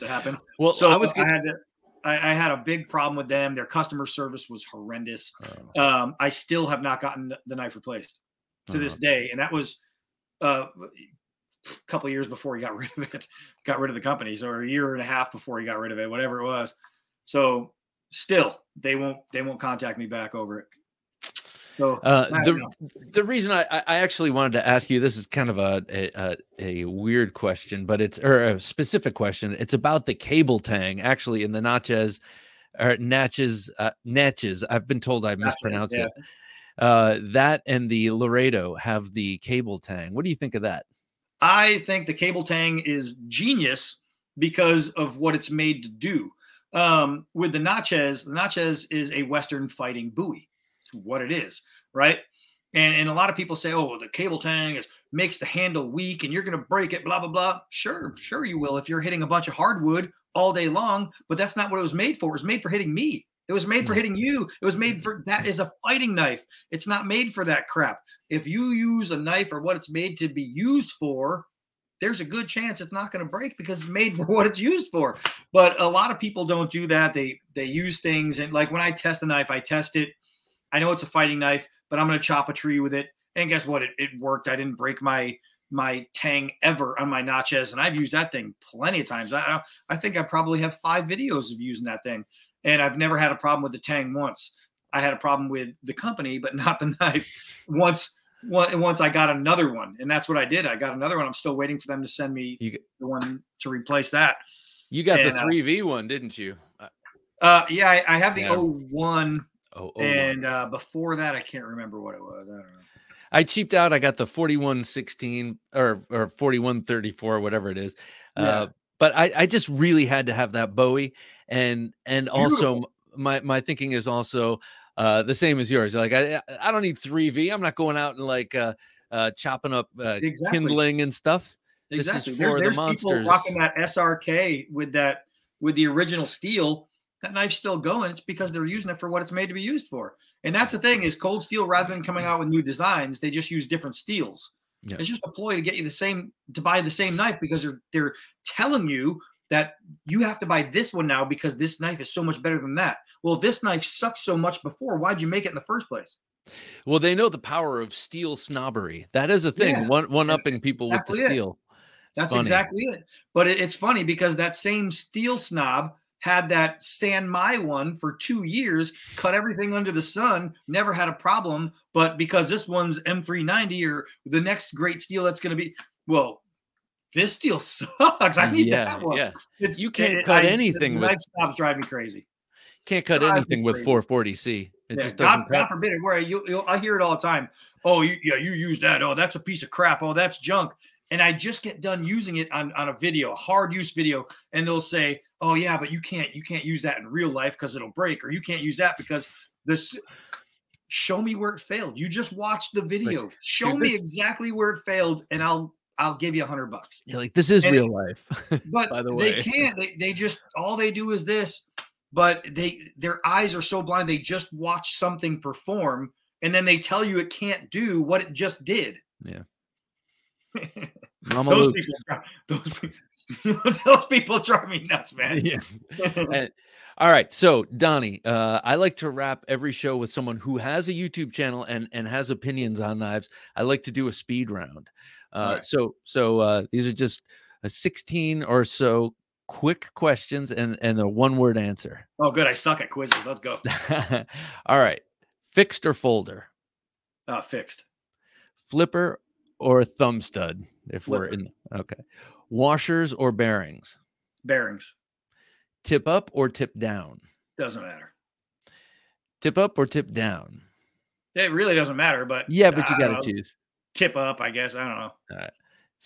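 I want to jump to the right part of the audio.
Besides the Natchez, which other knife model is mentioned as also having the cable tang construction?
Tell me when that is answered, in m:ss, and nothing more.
0:38.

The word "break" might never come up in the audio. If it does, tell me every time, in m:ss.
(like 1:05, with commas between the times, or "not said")
0:56, 1:13, 1:24, 3:17.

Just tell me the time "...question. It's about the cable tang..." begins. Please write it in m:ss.
0:29.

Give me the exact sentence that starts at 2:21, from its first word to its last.
Rather than coming out with new designs, they just use different steels.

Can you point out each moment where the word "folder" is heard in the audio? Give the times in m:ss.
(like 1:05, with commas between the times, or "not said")
4:05.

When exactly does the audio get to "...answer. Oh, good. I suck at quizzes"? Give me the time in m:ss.
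4:01.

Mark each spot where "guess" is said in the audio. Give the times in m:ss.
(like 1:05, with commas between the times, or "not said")
1:23, 4:24.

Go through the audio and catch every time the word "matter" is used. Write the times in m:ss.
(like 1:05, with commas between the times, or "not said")
4:17, 4:21.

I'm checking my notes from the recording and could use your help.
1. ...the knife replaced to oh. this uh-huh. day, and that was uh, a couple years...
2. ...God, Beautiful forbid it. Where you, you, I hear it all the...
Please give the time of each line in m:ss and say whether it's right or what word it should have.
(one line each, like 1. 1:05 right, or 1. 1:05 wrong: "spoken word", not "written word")
1. 0:07 right
2. 3:05 wrong: "God", not "Beautiful".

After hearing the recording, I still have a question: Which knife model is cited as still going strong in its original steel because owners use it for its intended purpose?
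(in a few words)
SRK.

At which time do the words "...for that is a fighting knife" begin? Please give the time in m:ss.
1:05.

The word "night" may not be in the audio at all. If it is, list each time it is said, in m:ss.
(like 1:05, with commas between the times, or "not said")
3:01.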